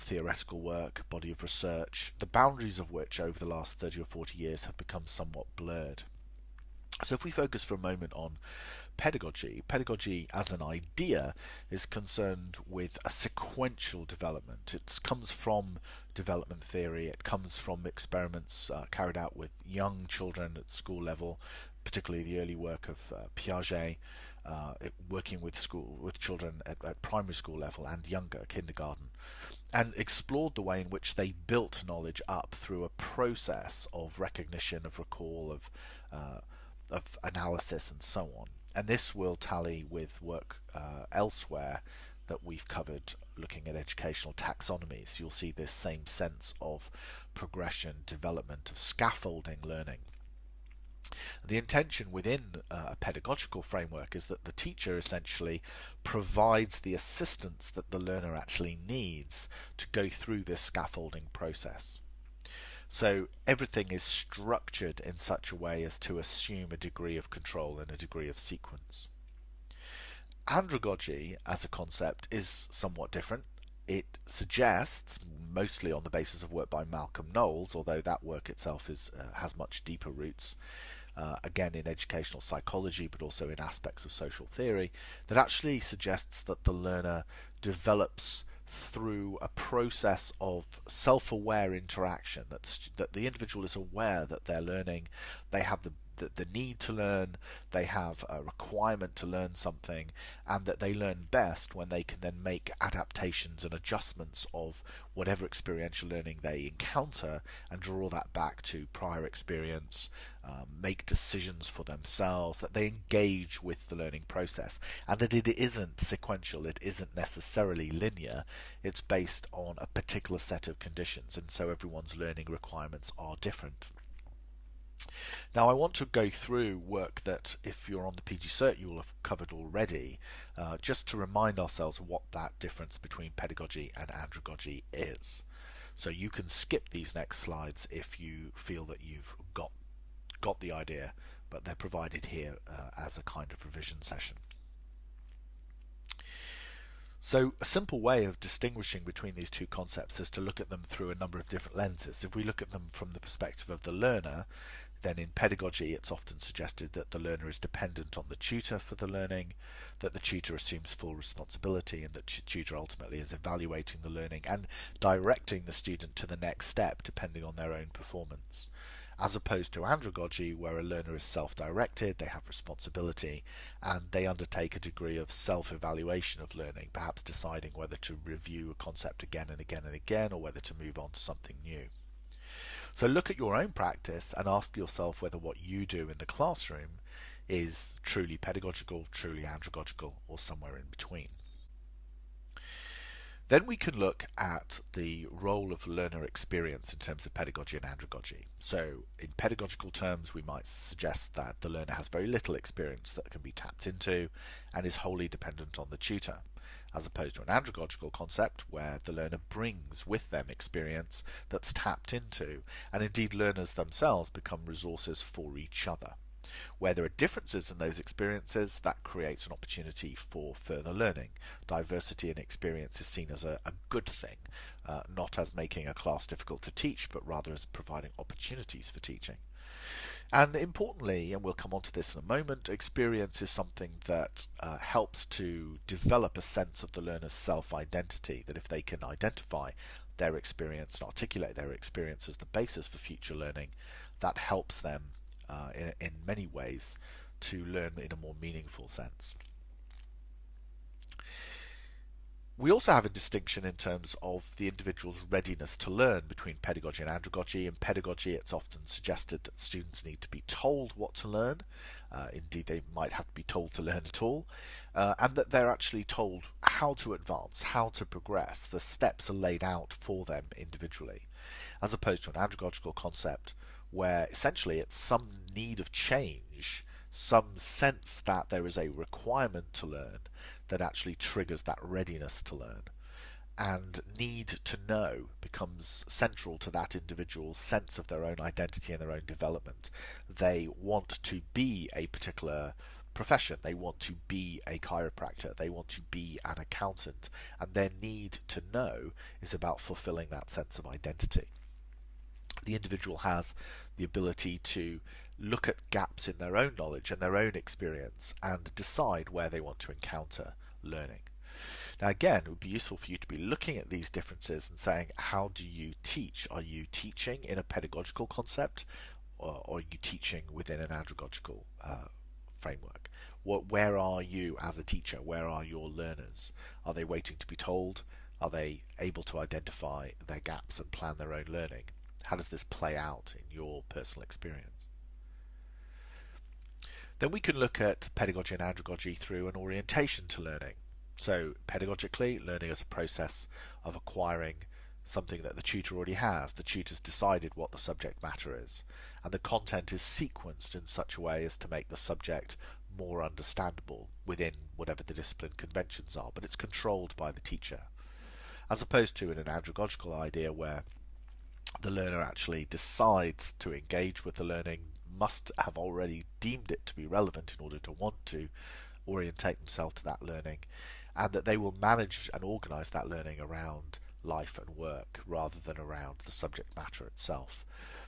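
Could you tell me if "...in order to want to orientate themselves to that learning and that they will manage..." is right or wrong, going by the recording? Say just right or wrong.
right.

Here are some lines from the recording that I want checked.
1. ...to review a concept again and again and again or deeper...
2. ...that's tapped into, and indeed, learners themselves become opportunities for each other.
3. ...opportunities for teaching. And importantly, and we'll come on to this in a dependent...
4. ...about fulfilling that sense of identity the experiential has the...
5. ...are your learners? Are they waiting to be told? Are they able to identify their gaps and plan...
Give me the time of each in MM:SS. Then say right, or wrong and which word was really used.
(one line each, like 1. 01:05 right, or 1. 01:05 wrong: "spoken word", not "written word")
1. 02:57 wrong: "whether", not "deeper"
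2. 03:31 wrong: "resources", not "opportunities"
3. 03:48 wrong: "moment", not "dependent"
4. 04:59 wrong: "individual", not "experiential"
5. 05:25 right.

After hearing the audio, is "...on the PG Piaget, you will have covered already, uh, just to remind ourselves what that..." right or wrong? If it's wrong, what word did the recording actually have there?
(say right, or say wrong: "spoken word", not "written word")
wrong: "Cert", not "Piaget".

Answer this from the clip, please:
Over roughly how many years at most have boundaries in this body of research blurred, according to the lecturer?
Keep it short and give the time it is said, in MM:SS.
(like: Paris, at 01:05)
40, at 00:04.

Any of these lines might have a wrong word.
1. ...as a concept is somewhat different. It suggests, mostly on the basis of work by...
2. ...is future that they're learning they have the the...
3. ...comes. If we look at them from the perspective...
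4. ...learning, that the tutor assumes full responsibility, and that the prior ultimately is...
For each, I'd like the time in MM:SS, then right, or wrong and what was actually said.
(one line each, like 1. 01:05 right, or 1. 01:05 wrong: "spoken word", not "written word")
1. 01:11 right
2. 01:33 wrong: "aware", not "future"
3. 02:31 wrong: "lenses", not "comes"
4. 02:39 wrong: "tutor", not "prior".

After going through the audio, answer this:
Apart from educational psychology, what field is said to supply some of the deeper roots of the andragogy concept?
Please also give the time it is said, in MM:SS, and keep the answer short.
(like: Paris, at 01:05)
Social theory, at 01:24.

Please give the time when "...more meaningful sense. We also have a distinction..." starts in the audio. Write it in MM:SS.
04:08.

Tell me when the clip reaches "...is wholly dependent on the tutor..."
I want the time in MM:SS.
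03:24.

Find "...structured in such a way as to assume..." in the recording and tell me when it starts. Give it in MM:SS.
01:04.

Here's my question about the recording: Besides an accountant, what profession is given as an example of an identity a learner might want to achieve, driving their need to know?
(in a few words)
Chiropractor.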